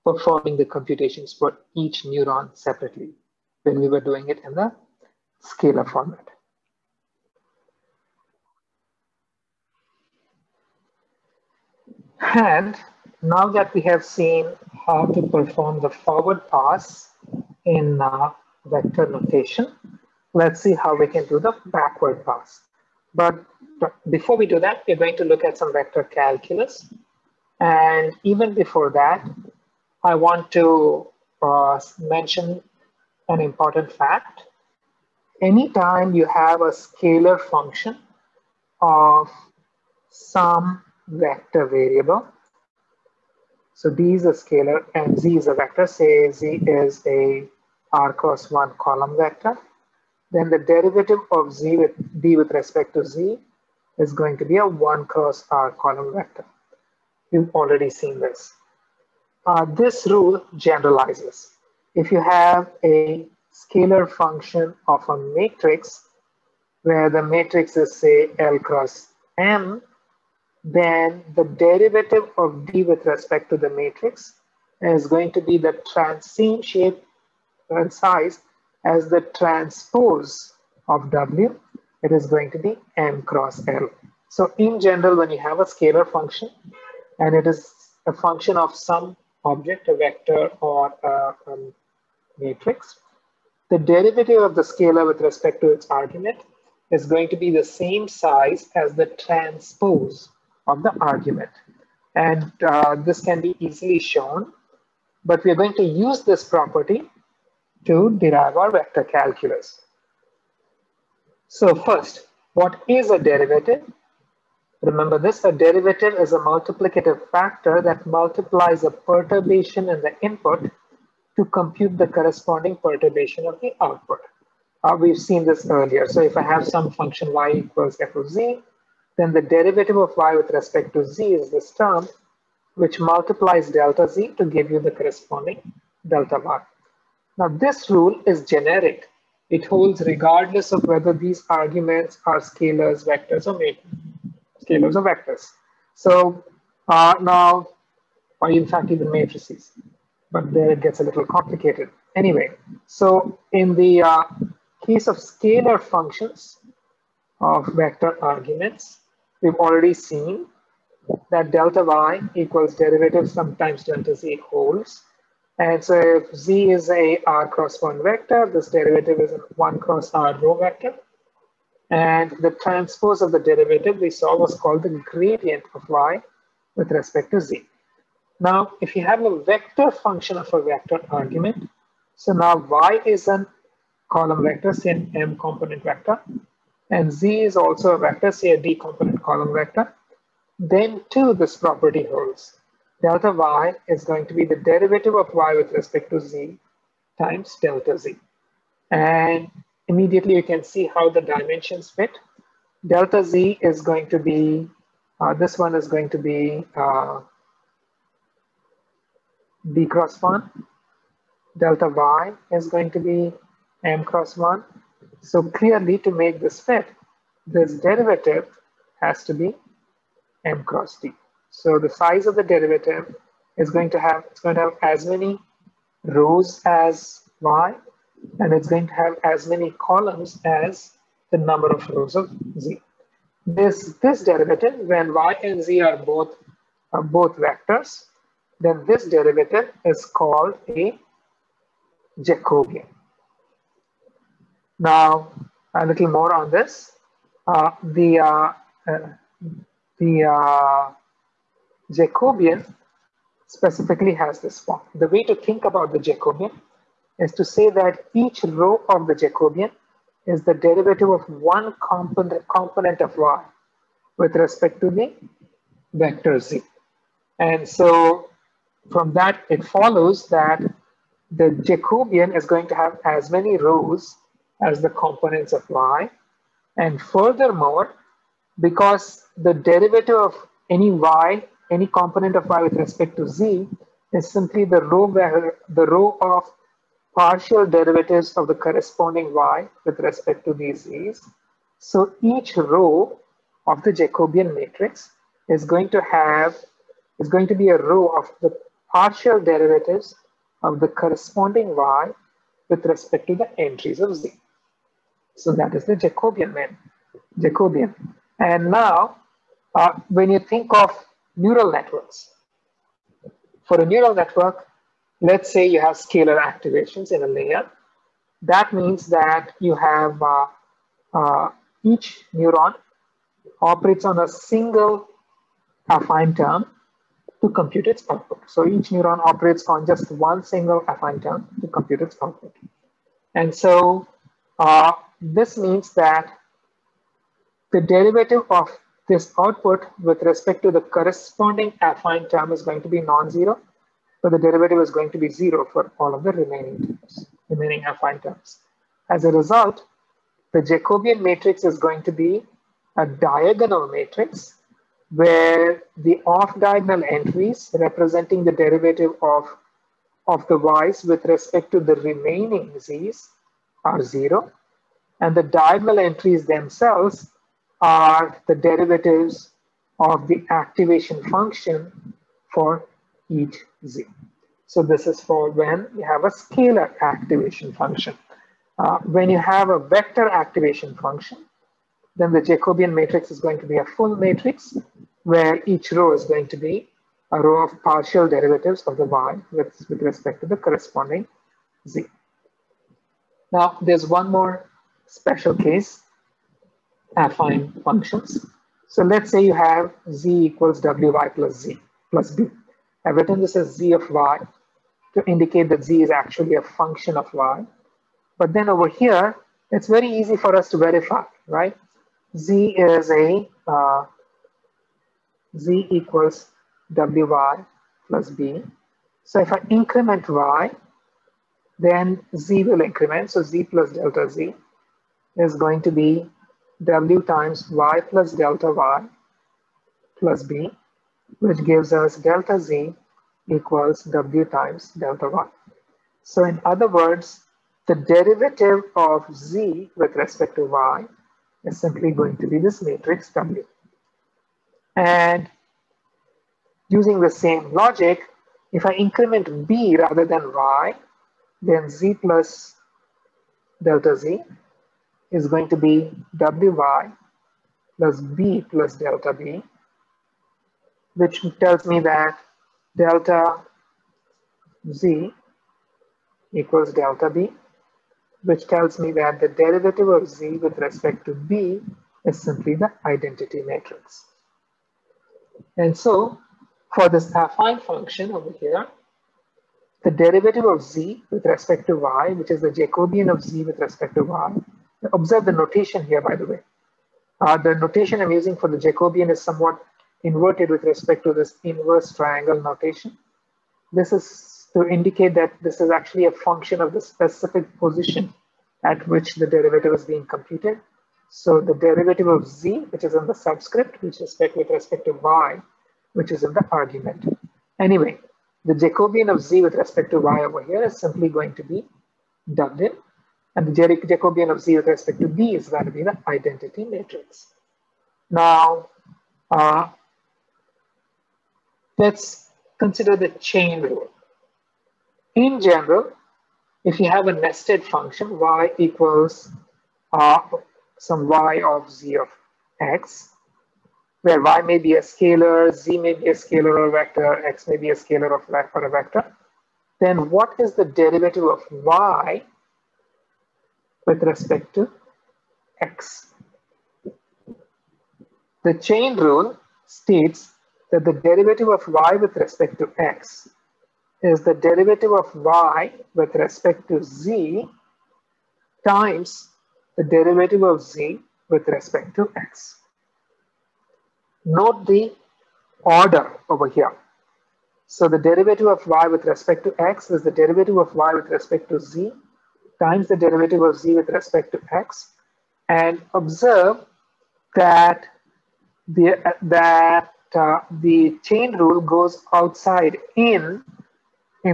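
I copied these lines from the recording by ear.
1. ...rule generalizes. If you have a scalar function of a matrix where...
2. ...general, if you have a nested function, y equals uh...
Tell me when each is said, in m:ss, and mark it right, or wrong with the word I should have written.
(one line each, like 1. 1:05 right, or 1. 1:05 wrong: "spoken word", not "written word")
1. 1:00 right
2. 8:45 right.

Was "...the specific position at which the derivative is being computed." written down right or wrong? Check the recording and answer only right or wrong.
right.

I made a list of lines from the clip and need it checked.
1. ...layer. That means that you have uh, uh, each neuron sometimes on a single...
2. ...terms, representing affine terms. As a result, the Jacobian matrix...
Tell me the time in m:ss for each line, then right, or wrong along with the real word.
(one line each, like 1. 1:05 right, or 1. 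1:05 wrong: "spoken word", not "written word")
1. 5:17 wrong: "operates", not "sometimes"
2. 5:46 wrong: "remaining", not "representing".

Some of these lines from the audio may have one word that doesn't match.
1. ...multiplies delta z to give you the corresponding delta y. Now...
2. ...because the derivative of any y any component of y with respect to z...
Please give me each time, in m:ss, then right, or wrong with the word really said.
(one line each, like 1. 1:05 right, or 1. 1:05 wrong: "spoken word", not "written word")
1. 2:13 right
2. 4:38 right.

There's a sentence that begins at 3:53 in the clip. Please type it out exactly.
This, this derivative, when y and z are both, are both vectors, then this derivative is called a Jacobian.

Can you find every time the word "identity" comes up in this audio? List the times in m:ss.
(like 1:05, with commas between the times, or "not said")
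7:53, 8:36.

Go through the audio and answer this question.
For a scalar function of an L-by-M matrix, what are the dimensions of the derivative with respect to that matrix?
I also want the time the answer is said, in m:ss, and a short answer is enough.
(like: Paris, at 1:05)
M cross L, at 1:22.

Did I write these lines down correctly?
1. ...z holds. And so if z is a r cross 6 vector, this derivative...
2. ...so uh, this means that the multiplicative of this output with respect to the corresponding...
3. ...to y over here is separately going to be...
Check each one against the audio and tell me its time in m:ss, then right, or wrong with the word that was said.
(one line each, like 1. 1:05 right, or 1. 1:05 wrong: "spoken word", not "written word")
1. 2:44 wrong: "1", not "6"
2. 5:33 wrong: "derivative", not "multiplicative"
3. 8:30 wrong: "simply", not "separately".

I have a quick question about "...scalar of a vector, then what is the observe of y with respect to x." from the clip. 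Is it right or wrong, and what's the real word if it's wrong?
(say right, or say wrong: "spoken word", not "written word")
wrong: "derivative", not "observe".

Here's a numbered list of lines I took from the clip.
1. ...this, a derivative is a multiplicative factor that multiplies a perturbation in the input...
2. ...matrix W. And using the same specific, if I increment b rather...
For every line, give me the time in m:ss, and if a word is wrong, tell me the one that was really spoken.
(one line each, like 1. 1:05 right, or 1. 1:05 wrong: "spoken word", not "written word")
1. 1:55 right
2. 7:22 wrong: "logic", not "specific".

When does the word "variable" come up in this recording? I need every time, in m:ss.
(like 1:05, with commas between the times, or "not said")
0:41.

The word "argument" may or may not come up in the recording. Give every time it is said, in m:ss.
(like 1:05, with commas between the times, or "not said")
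1:35, 1:41, 2:21, 2:38, 3:01, 8:26.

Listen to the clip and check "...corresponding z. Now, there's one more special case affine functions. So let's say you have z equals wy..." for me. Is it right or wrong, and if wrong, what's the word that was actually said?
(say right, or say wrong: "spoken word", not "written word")
right.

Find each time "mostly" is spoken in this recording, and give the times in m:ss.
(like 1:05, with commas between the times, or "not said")
not said.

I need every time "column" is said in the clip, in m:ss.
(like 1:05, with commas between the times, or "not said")
0:48, 0:55, 3:04, 3:09, 3:49.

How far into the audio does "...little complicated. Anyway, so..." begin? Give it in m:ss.
2:31.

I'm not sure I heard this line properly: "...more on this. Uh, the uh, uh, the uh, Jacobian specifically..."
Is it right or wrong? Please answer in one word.
right.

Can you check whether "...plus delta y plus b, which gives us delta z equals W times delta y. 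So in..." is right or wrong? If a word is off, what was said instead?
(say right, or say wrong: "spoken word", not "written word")
right.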